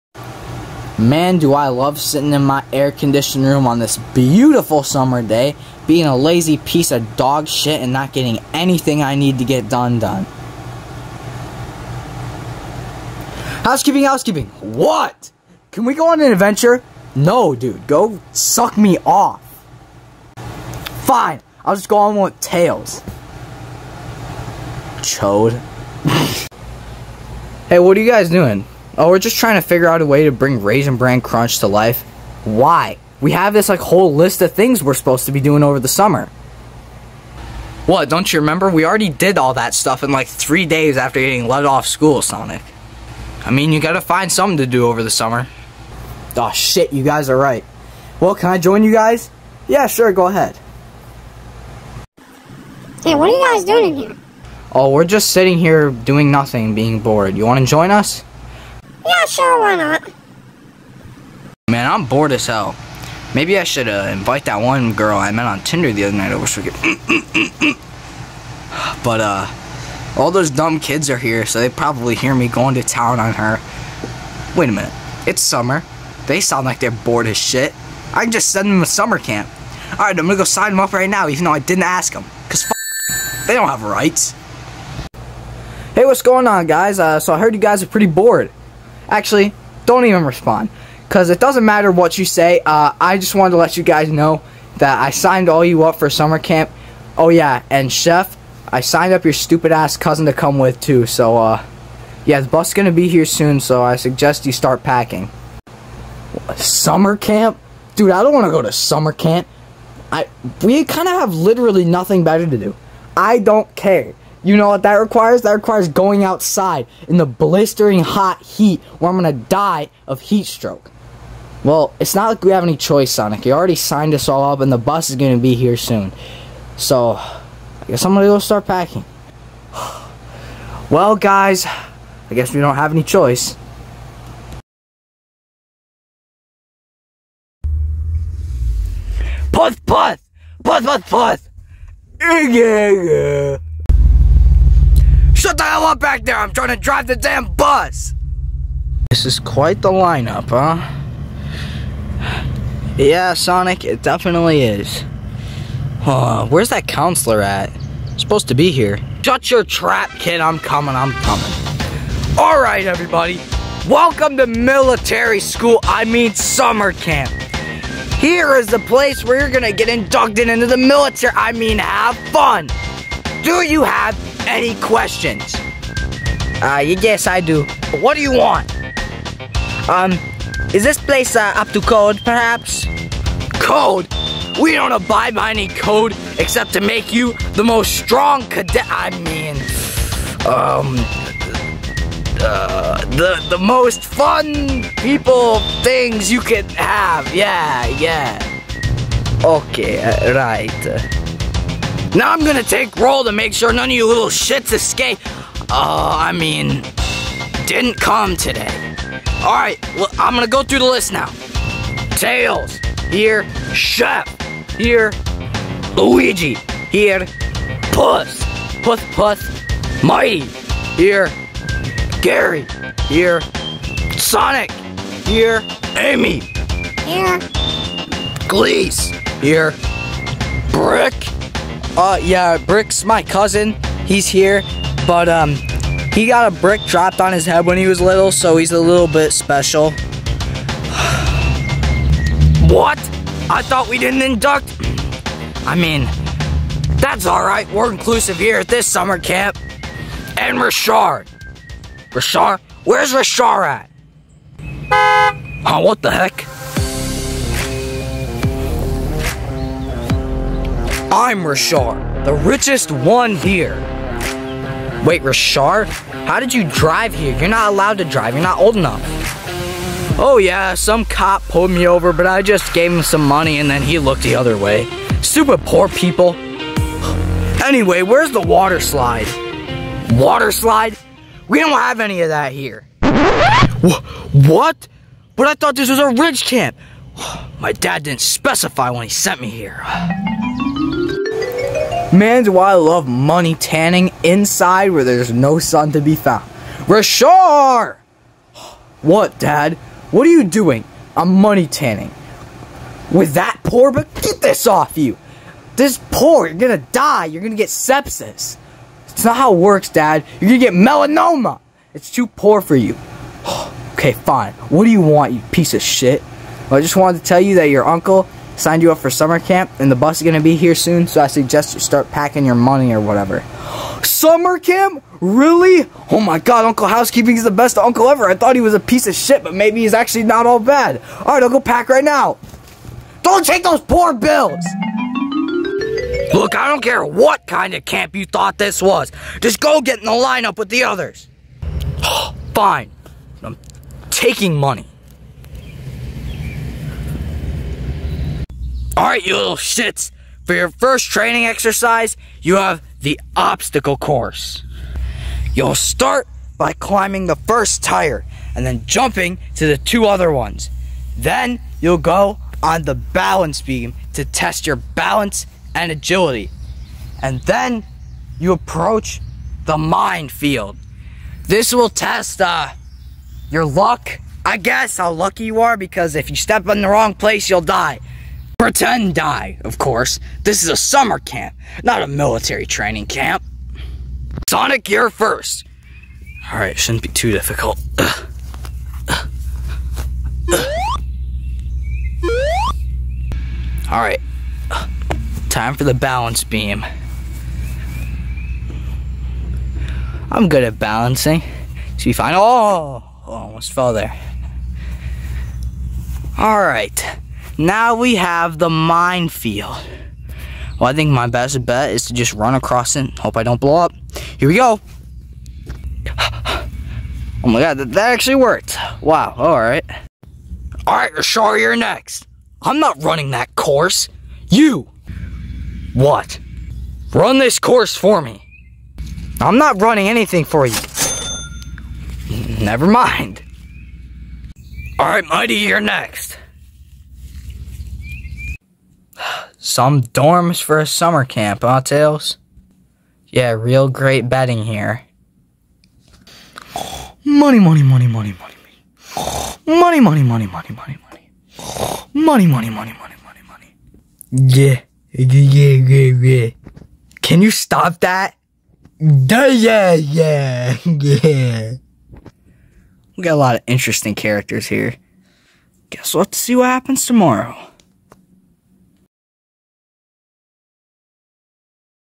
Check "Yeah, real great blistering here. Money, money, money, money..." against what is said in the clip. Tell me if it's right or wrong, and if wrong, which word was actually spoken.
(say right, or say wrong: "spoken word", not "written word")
wrong: "betting", not "blistering".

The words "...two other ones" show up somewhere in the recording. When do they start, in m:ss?
5:59.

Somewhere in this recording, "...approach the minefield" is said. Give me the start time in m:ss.
6:08.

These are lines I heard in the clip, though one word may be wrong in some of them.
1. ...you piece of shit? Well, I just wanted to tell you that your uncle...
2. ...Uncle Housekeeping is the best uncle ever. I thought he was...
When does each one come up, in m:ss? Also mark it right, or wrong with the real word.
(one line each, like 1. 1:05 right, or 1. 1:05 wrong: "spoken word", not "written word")
1. 5:15 right
2. 5:26 right.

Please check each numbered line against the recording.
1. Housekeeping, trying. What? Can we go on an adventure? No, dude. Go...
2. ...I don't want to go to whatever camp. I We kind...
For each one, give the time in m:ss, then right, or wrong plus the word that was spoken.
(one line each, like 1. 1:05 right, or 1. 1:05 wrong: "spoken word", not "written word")
1. 0:13 wrong: "housekeeping", not "trying"
2. 1:48 wrong: "summer", not "whatever".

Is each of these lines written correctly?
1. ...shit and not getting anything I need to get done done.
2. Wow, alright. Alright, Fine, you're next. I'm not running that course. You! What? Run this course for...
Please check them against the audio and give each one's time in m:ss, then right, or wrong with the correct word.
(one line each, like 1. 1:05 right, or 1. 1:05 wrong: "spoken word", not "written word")
1. 0:07 right
2. 6:58 wrong: "Rashar", not "Fine".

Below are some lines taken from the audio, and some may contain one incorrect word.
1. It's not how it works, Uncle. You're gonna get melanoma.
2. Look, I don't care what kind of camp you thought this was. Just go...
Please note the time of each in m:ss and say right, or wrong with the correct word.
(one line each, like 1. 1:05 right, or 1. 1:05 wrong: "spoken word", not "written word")
1. 5:09 wrong: "Dad", not "Uncle"
2. 5:36 right.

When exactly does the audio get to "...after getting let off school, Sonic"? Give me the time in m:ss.
0:40.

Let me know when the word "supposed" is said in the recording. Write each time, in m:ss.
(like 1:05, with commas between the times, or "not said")
0:34, 2:38.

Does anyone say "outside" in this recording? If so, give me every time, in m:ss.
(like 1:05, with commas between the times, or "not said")
1:56.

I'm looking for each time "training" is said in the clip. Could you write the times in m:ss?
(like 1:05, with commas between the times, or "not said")
5:51, 6:22.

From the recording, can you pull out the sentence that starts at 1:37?
Oh, yeah, and Chef, I signed up your stupid ass cousin to come with, too.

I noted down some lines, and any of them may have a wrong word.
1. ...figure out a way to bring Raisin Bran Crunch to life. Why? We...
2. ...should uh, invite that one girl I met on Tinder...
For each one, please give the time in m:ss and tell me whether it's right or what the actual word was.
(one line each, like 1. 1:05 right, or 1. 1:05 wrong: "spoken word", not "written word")
1. 0:29 right
2. 1:03 right.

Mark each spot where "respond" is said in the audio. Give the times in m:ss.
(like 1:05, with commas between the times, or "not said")
1:30.